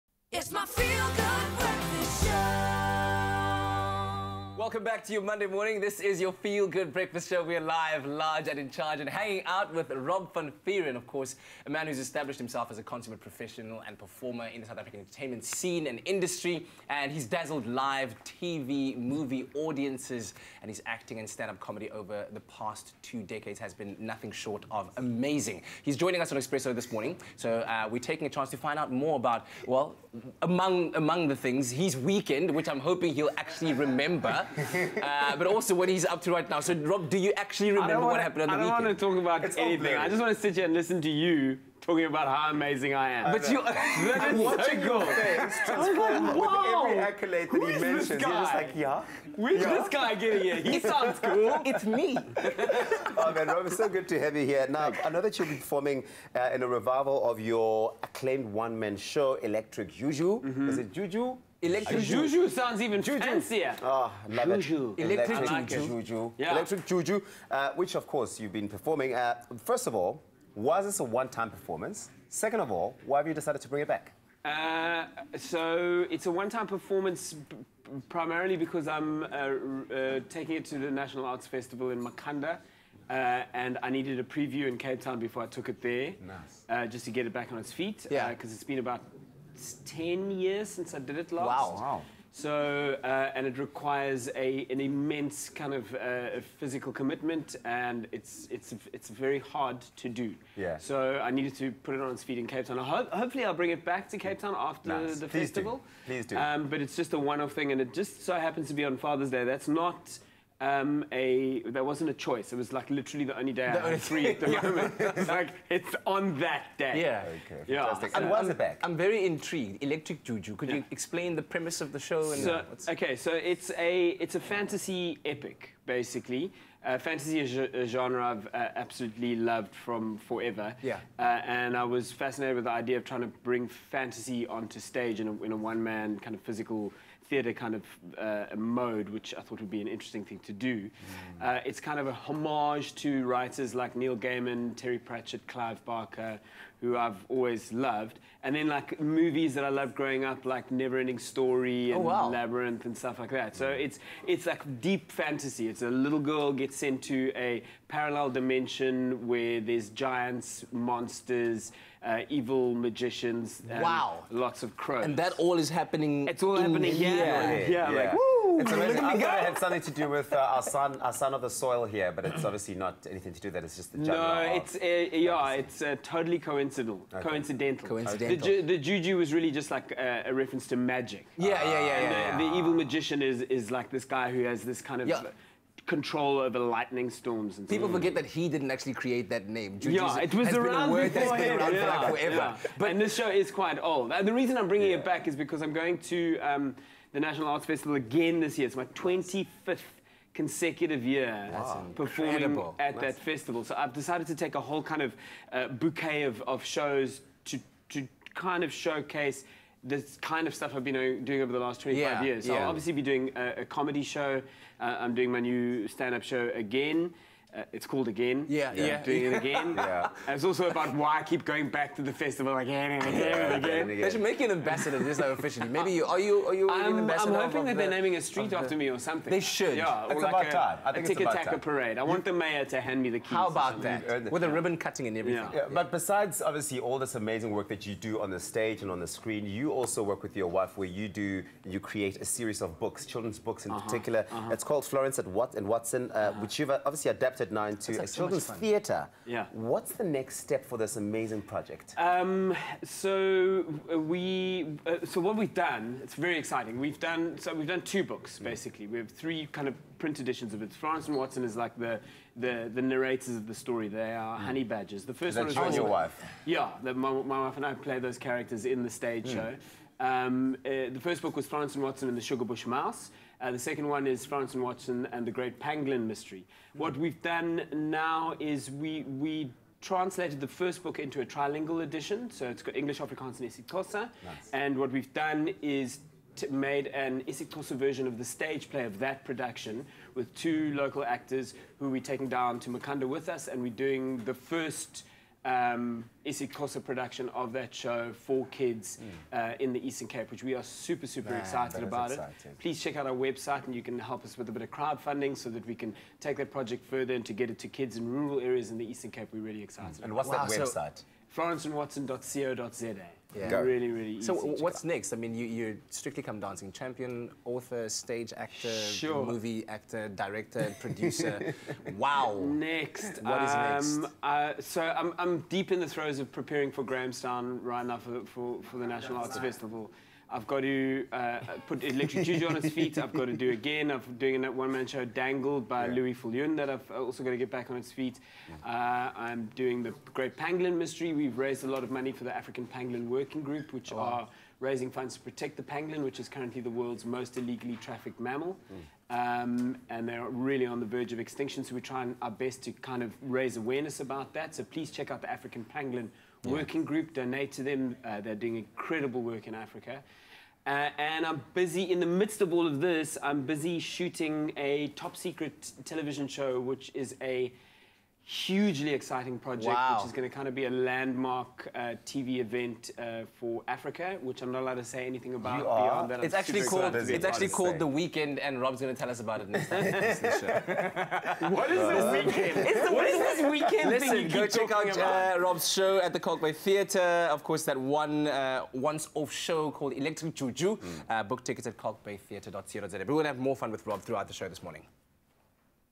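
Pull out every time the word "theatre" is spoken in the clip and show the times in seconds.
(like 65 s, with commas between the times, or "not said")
137 s, 248 s, 386 s.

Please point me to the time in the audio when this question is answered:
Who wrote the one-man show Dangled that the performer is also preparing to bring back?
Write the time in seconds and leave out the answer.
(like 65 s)
335 s.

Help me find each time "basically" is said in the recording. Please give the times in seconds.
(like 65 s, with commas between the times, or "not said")
125 s, 258 s.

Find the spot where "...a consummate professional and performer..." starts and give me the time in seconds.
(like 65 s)
12 s.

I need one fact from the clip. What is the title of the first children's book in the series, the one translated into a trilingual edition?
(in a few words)
Florence and Watson and the Sugarbush Mouse.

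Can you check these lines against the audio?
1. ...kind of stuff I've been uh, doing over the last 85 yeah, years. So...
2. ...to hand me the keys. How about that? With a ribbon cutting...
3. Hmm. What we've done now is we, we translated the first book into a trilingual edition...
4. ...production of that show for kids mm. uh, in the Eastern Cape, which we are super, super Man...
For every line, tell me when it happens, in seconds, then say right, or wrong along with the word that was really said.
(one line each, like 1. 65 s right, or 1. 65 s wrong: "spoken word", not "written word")
1. 210 s wrong: "25", not "85"
2. 232 s right
3. 276 s right
4. 296 s right.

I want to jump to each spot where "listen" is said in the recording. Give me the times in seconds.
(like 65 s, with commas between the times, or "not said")
40 s, 383 s.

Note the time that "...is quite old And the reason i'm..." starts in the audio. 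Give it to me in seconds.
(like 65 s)
193 s.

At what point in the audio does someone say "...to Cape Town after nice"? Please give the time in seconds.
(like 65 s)
104 s.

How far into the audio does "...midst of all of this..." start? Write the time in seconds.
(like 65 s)
362 s.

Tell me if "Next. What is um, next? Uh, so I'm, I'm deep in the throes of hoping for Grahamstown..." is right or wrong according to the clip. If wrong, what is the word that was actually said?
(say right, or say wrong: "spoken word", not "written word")
wrong: "preparing", not "hoping".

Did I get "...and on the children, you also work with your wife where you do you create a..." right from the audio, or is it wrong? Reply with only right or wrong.
wrong.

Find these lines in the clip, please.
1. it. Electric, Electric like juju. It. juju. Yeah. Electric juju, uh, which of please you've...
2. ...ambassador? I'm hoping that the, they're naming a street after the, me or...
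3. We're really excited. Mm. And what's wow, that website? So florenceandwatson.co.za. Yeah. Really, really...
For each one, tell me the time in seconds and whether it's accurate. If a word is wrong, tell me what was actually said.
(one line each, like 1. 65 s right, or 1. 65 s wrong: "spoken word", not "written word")
1. 64 s wrong: "course", not "please"
2. 226 s right
3. 309 s right.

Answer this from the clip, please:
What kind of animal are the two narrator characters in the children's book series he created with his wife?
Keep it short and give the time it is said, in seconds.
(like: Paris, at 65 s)
Honey badgers, at 264 s.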